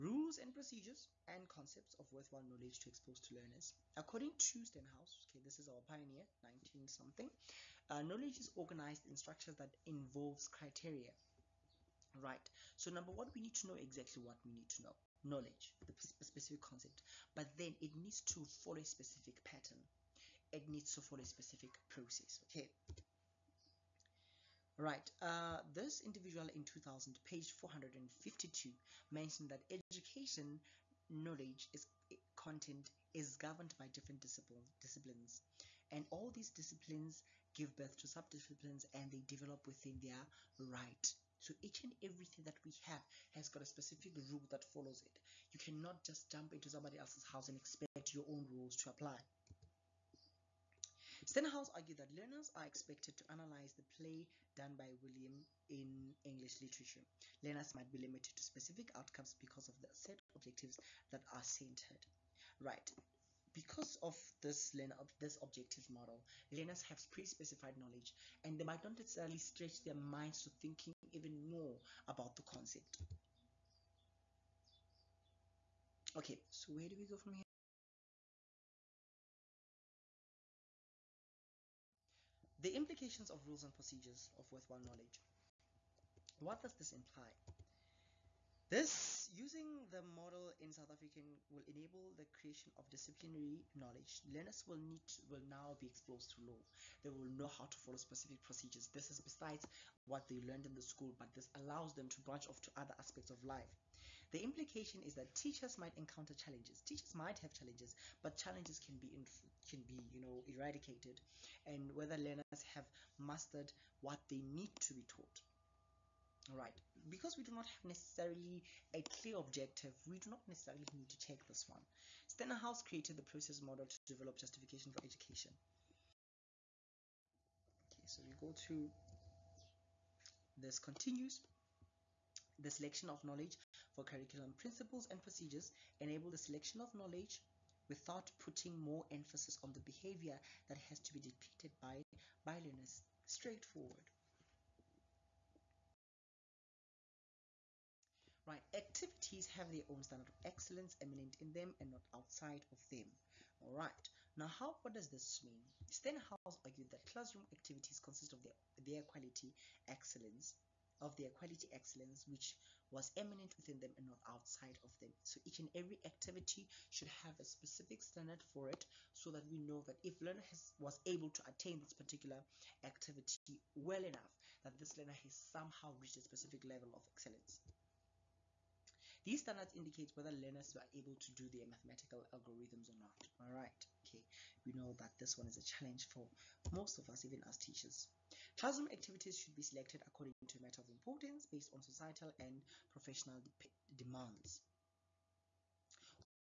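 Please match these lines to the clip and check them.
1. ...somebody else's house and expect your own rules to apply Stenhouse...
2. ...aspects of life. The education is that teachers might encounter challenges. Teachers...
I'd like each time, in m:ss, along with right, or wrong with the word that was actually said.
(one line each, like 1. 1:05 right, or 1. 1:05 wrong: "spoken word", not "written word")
1. 0:46 right
2. 1:42 wrong: "implication", not "education".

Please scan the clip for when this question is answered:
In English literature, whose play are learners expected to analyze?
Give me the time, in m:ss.
0:54.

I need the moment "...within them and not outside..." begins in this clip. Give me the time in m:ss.
2:43.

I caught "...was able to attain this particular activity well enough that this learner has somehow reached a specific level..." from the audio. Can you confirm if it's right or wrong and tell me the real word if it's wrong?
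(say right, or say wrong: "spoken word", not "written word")
right.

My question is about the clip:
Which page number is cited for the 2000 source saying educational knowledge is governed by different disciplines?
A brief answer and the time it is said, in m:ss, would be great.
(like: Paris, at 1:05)
452, at 0:27.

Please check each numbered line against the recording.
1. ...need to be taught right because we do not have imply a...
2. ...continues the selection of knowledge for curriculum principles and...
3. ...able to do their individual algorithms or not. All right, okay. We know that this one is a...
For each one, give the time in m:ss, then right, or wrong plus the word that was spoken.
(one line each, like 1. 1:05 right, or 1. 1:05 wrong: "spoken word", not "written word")
1. 1:54 wrong: "necessarily", not "imply"
2. 2:10 right
3. 3:00 wrong: "mathematical", not "individual".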